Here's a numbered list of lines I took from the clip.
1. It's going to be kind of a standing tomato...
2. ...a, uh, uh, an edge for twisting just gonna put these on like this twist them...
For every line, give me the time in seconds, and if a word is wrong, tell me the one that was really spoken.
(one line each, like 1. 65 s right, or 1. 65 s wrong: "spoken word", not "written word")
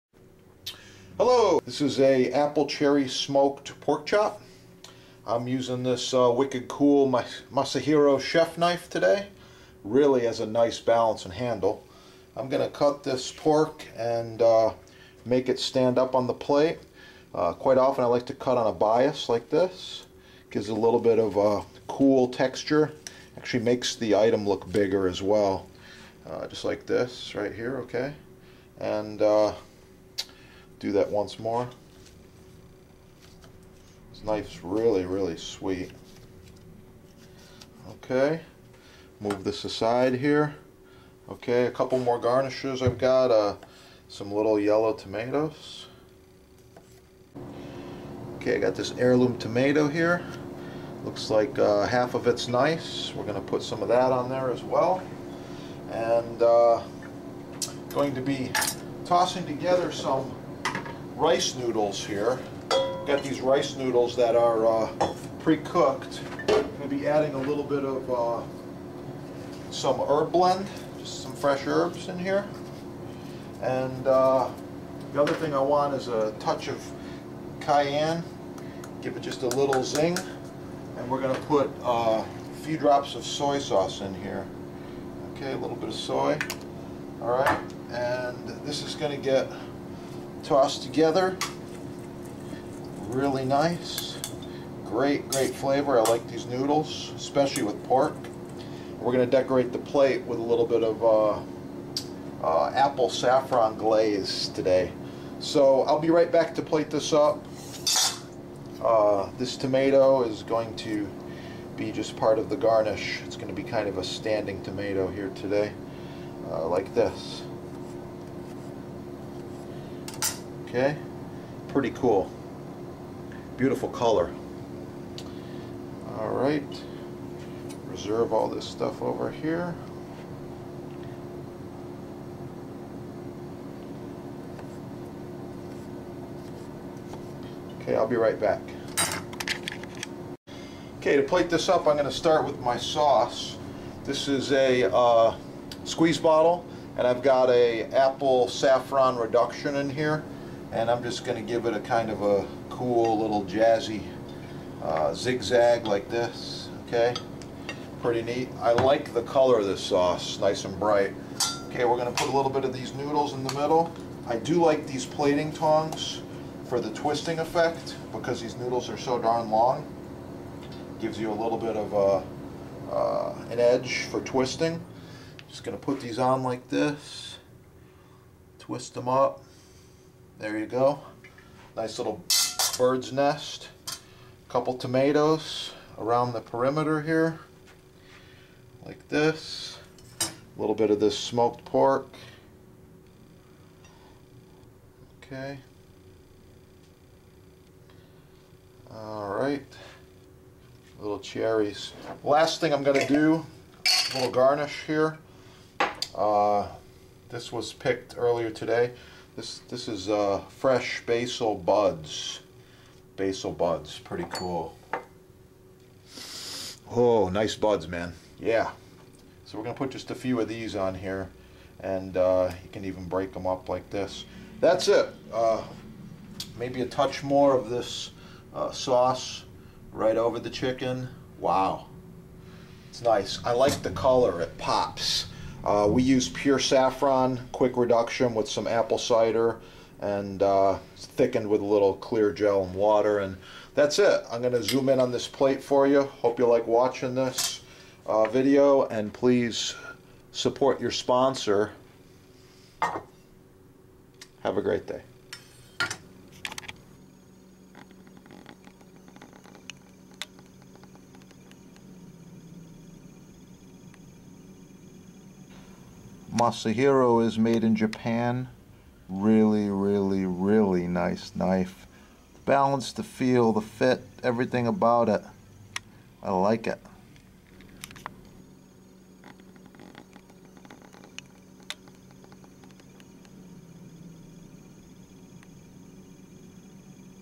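1. 113 s right
2. 171 s right.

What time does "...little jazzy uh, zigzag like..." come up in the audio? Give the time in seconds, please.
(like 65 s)
153 s.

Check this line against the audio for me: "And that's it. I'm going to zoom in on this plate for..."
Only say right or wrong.
right.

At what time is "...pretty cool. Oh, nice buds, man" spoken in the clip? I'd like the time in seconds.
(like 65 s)
213 s.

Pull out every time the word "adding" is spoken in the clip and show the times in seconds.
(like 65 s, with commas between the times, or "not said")
67 s.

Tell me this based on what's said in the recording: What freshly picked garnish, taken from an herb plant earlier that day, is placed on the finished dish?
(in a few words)
Basil buds.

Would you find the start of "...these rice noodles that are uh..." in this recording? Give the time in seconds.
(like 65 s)
63 s.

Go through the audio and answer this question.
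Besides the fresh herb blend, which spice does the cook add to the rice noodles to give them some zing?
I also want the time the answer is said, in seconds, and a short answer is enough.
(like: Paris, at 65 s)
Cayenne, at 77 s.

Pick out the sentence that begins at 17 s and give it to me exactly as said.
Uh, quite often I like to cut on a bias like this.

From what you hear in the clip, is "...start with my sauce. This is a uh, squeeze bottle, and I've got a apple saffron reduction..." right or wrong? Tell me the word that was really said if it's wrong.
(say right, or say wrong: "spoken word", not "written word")
right.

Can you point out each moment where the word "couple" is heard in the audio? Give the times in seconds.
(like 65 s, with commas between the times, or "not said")
41 s, 184 s.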